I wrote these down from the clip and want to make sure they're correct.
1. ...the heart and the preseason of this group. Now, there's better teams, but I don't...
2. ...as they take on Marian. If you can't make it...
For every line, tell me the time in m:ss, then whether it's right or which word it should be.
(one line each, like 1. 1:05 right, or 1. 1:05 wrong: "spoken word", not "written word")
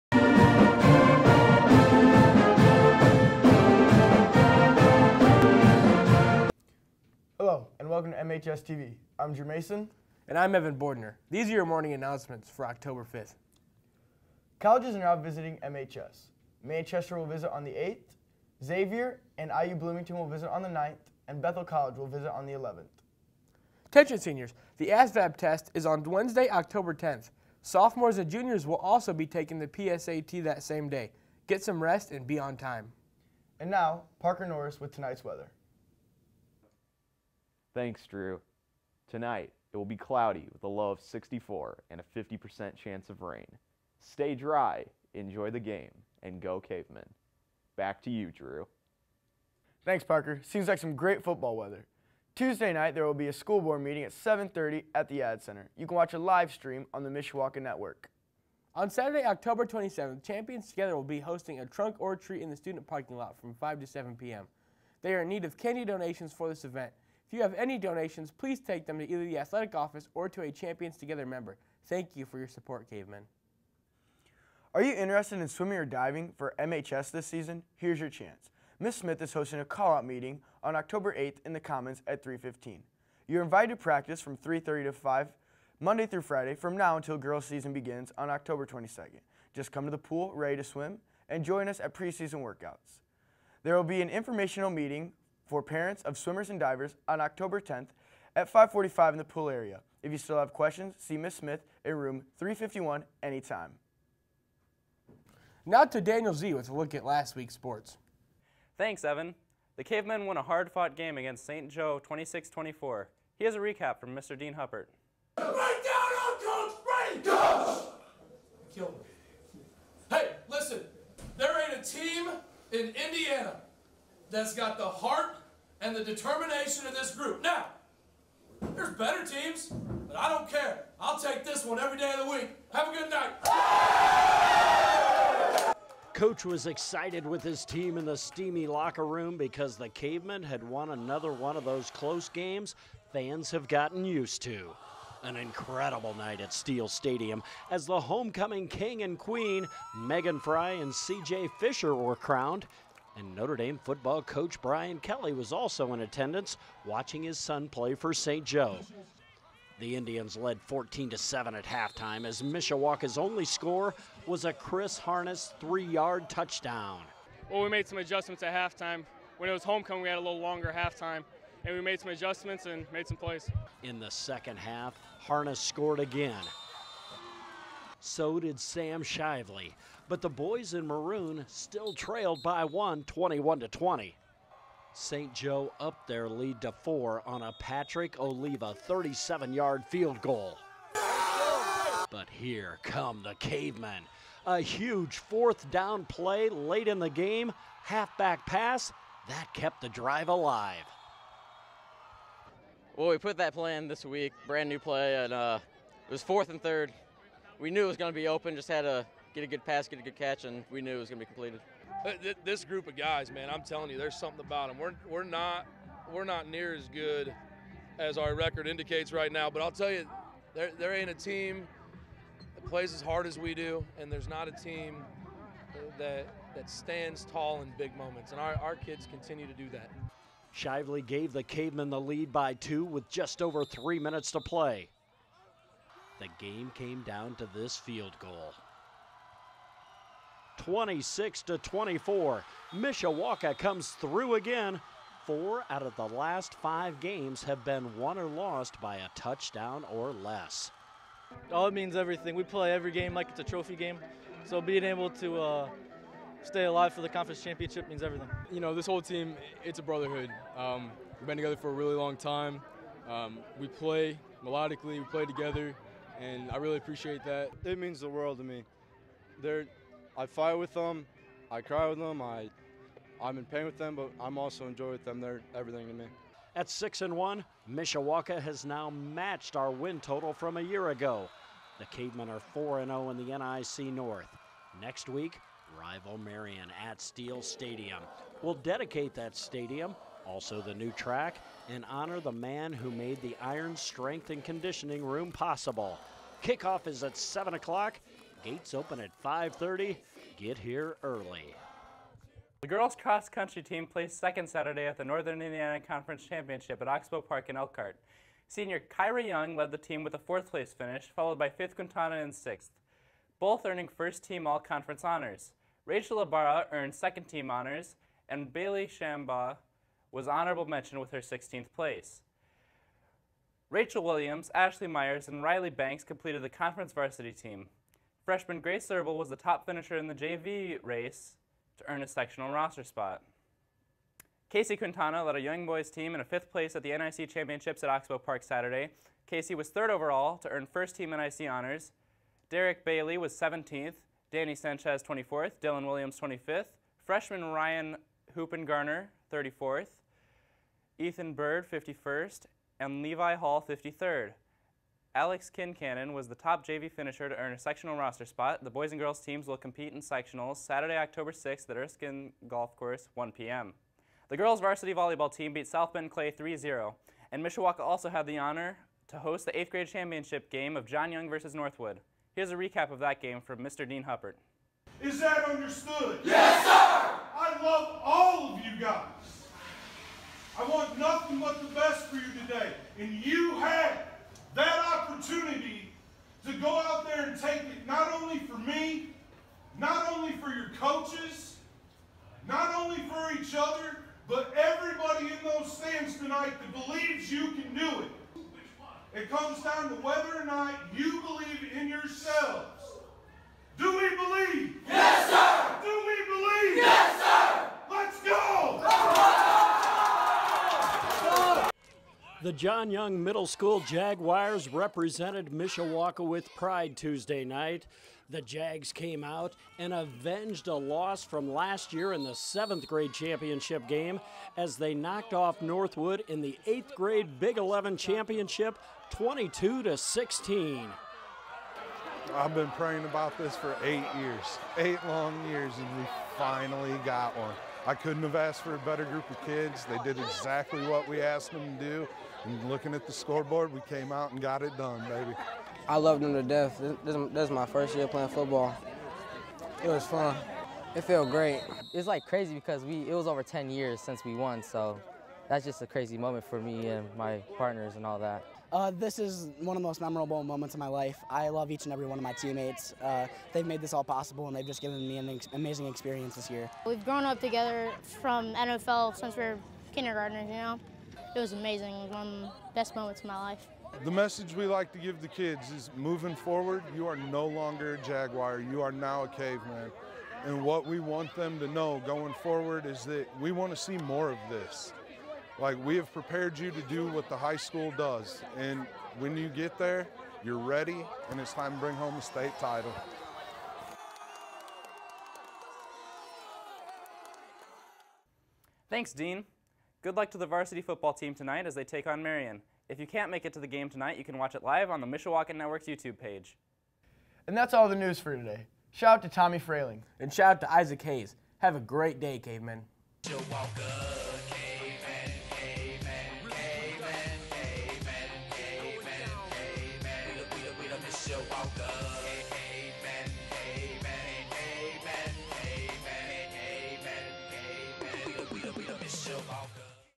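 1. 2:04 wrong: "determination", not "preseason"
2. 8:21 right.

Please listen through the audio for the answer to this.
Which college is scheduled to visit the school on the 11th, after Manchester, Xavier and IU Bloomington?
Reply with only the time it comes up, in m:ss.
0:21.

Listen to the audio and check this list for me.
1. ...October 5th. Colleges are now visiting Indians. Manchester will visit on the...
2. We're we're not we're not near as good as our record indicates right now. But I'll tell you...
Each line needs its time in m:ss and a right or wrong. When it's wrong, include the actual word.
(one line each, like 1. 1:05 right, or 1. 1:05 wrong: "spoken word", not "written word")
1. 0:12 wrong: "MHS", not "Indians"
2. 3:34 right.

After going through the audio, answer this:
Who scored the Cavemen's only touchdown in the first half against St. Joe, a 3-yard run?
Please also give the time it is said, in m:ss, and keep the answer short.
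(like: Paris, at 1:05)
Chris Harness, at 2:44.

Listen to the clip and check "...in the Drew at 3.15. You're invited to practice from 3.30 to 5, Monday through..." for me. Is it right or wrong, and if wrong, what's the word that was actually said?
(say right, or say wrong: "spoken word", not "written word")
wrong: "Commons", not "Drew".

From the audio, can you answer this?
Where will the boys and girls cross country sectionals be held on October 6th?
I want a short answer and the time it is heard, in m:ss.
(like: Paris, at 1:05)
Erskine Golf Course, at 6:01.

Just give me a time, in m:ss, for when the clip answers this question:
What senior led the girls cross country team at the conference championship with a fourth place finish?
5:08.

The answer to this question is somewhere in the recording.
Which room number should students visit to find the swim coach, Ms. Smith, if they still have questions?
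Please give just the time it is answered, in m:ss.
1:42.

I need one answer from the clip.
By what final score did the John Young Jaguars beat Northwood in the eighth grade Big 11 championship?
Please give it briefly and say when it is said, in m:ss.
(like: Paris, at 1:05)
22-16, at 7:09.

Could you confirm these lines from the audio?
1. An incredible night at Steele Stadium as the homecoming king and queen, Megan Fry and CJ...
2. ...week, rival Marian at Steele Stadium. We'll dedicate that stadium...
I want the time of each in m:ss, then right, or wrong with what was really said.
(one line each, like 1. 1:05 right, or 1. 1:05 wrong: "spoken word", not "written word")
1. 2:25 right
2. 4:45 right.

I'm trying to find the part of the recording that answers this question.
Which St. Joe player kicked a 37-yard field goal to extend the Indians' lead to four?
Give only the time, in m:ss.
3:07.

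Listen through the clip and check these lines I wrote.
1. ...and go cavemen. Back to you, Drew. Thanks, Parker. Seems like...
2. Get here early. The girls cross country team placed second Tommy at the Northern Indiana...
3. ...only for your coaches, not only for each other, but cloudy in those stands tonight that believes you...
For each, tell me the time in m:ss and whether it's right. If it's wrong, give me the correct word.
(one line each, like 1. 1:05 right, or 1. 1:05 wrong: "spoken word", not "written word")
1. 0:46 right
2. 5:00 wrong: "Saturday", not "Tommy"
3. 6:30 wrong: "everybody", not "cloudy".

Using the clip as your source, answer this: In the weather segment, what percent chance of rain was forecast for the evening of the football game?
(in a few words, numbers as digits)
50%.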